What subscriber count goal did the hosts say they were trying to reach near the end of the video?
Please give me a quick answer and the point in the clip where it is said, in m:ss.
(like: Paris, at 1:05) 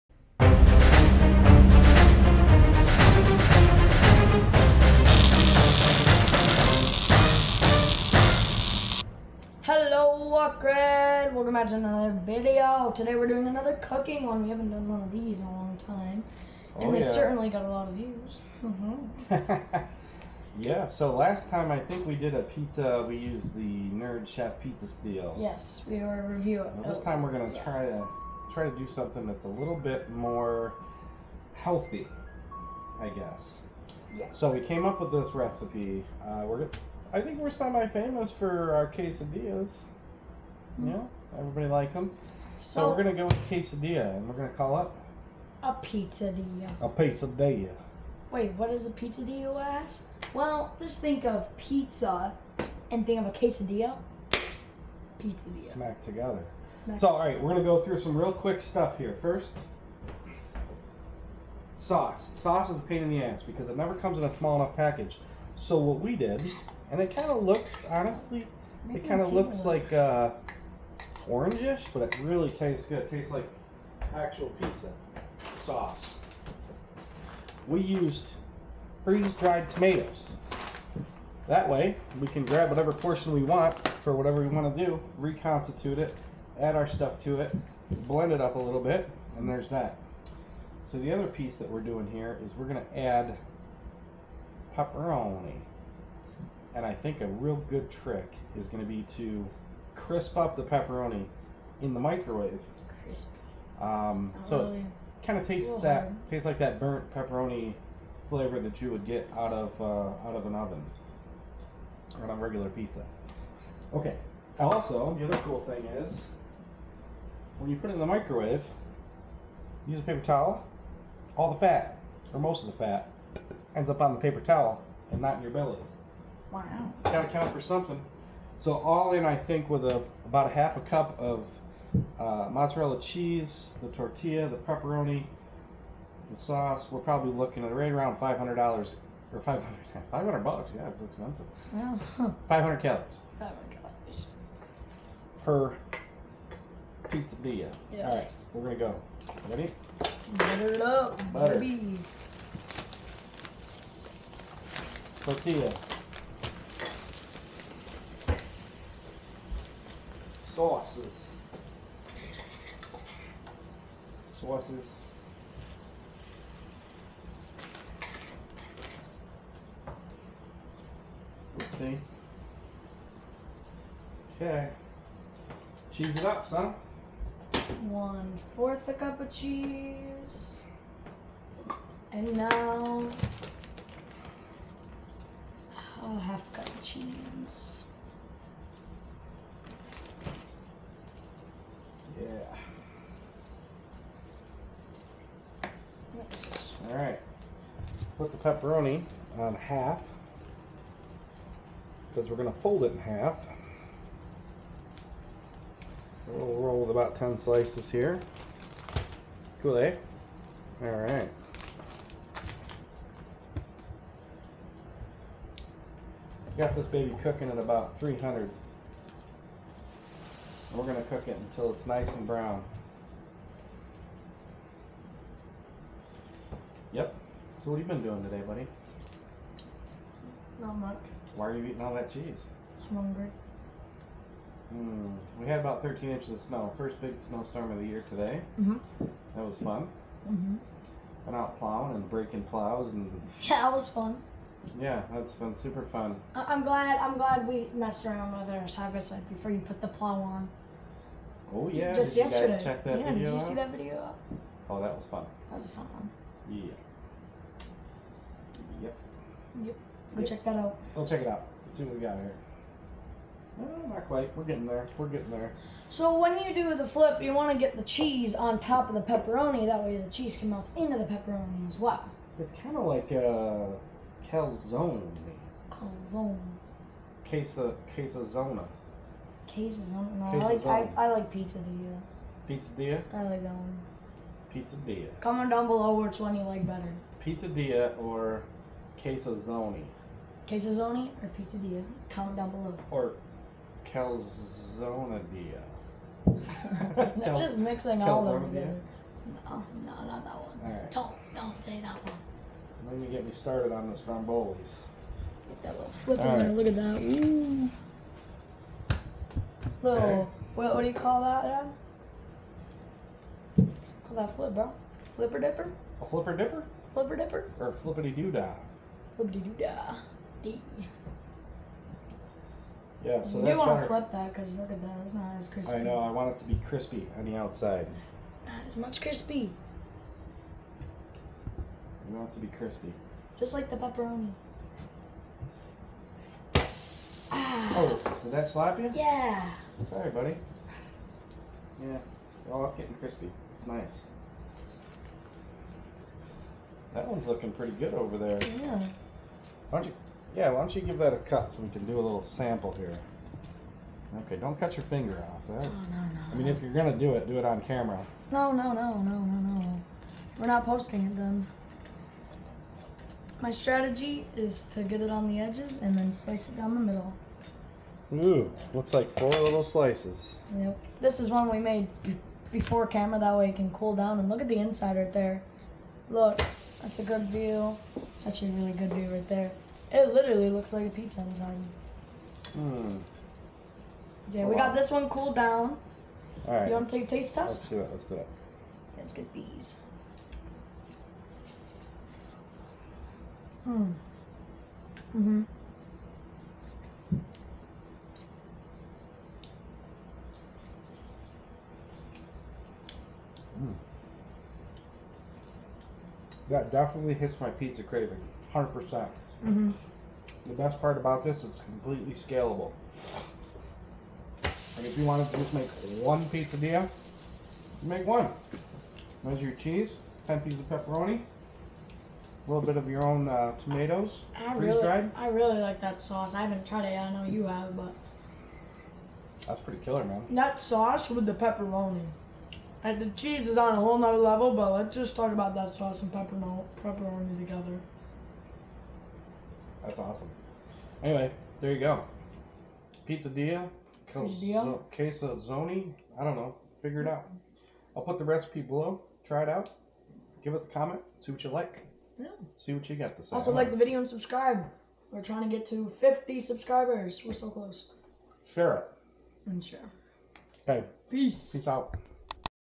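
50 subscribers, at 7:35.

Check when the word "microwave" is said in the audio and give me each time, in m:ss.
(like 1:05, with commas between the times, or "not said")
1:41, 1:58.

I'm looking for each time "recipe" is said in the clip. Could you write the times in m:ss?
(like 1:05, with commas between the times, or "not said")
0:35, 7:28.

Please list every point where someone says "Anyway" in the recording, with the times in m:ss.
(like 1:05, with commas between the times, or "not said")
7:21.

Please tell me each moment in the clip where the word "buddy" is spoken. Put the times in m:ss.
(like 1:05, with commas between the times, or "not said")
3:48, 5:40.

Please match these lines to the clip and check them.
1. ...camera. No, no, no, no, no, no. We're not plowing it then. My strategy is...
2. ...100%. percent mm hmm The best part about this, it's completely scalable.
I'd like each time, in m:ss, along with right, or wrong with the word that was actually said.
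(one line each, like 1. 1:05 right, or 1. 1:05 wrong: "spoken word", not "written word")
1. 5:57 wrong: "posting", not "plowing"
2. 6:48 right.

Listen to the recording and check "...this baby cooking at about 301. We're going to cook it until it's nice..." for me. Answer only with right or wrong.
wrong.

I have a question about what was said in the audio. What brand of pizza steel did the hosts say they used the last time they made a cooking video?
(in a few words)
Nerd Chef.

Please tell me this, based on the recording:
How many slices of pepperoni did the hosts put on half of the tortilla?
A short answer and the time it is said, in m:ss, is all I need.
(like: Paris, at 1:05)
10, at 3:27.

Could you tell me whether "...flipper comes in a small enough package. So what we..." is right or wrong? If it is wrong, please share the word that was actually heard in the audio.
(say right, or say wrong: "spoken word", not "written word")
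wrong: "never", not "flipper".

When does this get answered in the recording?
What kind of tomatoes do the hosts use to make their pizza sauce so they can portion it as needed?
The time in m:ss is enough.
1:19.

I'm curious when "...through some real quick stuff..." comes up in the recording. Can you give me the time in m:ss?
0:57.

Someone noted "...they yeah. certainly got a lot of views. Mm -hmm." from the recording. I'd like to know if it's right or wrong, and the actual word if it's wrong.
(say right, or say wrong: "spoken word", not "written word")
right.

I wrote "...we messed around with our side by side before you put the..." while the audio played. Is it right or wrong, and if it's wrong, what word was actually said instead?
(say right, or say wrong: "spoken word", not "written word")
right.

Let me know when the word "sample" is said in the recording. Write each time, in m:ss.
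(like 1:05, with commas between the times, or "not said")
5:52.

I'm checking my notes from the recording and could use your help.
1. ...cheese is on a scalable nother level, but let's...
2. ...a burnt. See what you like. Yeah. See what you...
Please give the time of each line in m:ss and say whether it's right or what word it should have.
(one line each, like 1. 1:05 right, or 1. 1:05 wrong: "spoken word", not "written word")
1. 7:13 wrong: "whole", not "scalable"
2. 7:30 wrong: "comment", not "burnt".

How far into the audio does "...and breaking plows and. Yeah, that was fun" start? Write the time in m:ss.
4:01.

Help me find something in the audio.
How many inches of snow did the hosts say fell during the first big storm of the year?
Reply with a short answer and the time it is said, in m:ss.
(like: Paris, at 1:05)
13 inches, at 3:55.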